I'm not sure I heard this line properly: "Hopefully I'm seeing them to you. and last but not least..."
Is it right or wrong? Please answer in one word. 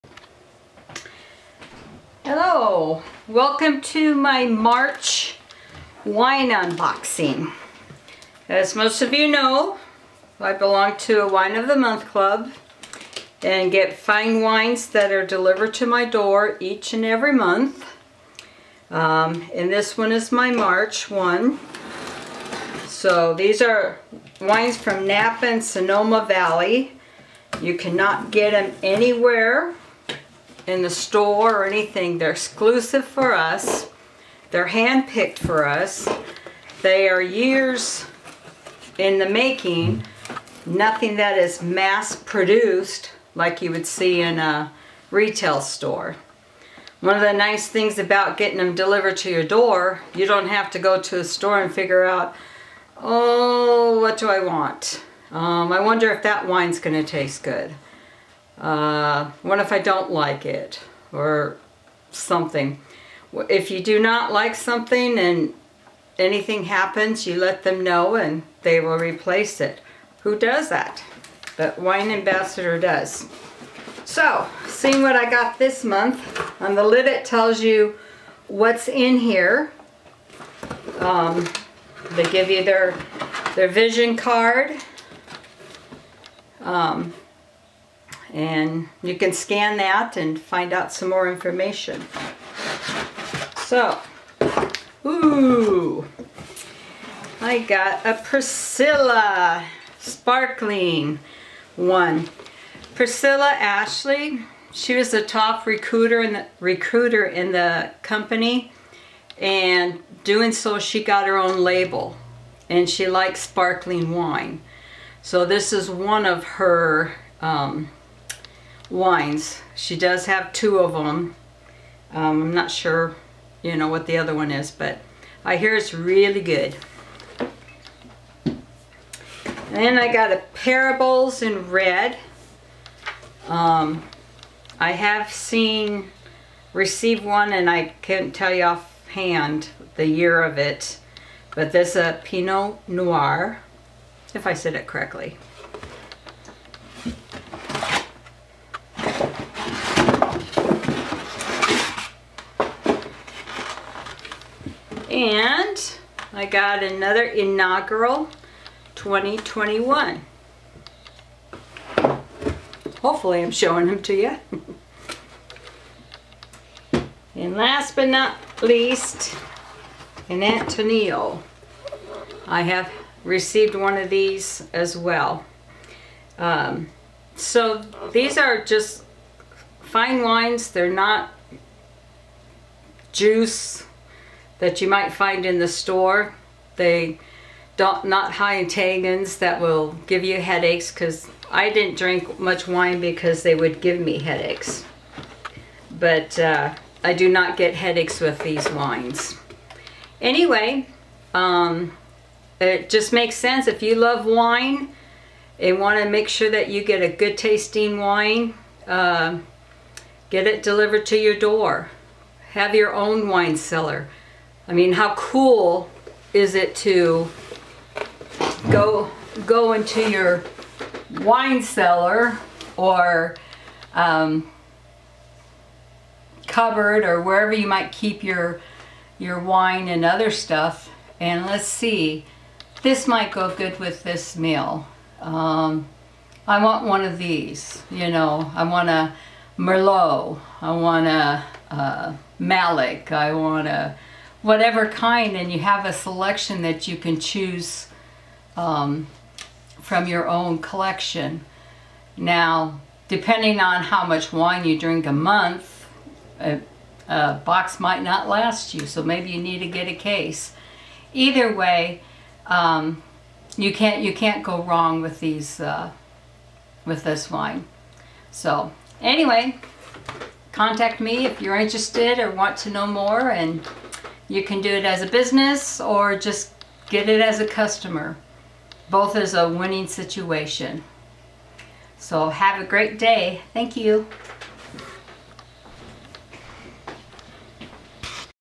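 wrong.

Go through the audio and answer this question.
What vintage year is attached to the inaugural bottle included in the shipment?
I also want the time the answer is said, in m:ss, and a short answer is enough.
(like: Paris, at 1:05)
2021, at 2:38.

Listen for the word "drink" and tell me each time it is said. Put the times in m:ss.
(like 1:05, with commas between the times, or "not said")
3:11, 4:14.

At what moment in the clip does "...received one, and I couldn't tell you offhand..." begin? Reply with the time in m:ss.
2:16.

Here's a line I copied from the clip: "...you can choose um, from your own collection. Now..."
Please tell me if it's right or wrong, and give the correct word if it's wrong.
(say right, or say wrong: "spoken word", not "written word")
right.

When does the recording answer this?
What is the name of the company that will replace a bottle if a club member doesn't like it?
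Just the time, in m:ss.
1:11.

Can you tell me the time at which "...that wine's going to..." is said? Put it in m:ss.
0:56.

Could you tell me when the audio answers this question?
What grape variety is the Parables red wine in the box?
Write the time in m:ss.
2:22.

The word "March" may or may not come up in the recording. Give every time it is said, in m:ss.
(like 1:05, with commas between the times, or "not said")
0:04, 0:20.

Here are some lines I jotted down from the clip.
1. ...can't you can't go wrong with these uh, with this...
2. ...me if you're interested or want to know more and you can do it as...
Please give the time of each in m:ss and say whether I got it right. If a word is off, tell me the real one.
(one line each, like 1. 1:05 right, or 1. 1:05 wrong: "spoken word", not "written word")
1. 4:23 right
2. 4:31 right.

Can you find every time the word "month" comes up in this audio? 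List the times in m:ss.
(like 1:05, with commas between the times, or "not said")
0:11, 0:17, 1:15, 4:15.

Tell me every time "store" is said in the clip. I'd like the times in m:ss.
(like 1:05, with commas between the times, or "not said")
0:30, 0:45, 0:51, 3:05.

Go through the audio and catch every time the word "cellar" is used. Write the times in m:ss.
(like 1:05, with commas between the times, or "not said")
3:33, 3:41.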